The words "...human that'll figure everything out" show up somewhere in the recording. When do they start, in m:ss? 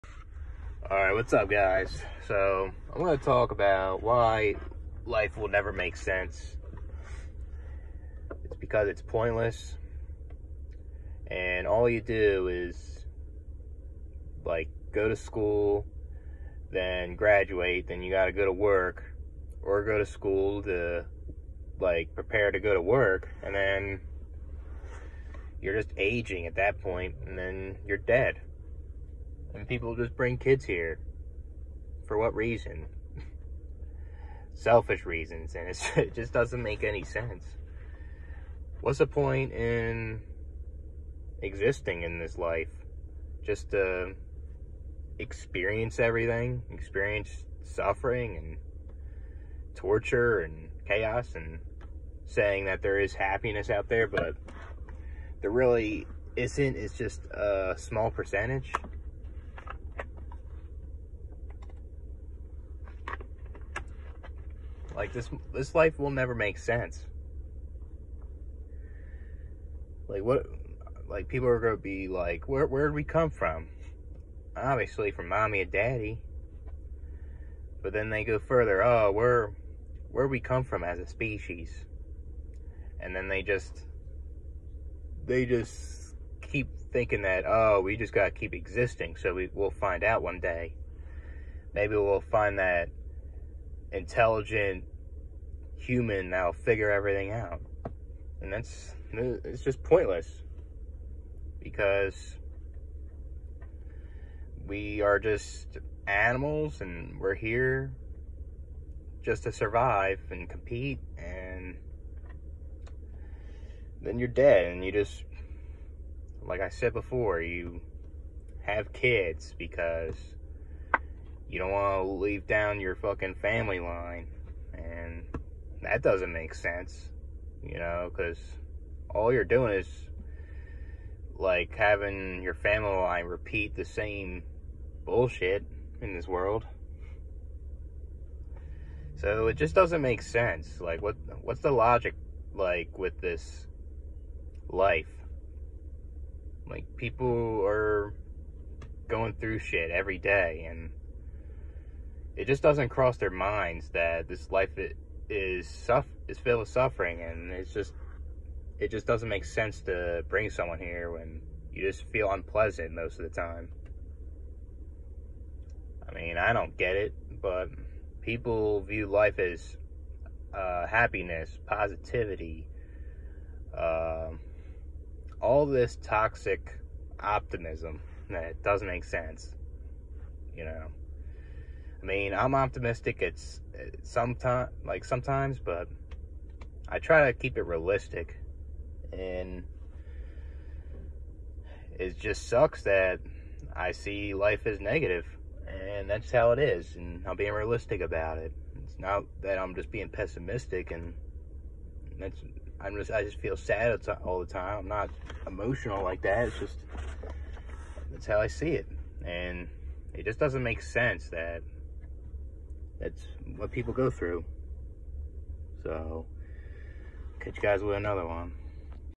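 1:35.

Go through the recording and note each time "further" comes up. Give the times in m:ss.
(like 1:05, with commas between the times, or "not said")
1:18.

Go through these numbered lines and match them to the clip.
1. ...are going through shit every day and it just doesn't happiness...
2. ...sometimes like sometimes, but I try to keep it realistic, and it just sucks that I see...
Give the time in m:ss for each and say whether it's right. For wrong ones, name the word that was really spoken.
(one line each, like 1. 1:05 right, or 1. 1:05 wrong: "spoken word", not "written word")
1. 2:27 wrong: "cross", not "happiness"
2. 3:04 right.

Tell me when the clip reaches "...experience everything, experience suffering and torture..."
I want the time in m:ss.
0:45.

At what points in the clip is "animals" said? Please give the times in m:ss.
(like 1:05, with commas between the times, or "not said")
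1:46.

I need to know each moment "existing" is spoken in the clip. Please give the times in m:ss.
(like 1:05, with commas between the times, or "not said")
0:41, 1:28.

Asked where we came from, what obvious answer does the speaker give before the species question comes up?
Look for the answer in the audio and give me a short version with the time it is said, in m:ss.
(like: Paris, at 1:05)
Mommy and daddy, at 1:15.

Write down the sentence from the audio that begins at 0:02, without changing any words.
So I'm gonna talk about why life will never make sense.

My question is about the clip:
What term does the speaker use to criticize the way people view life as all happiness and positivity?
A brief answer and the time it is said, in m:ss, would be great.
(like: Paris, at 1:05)
Toxic optimism, at 2:56.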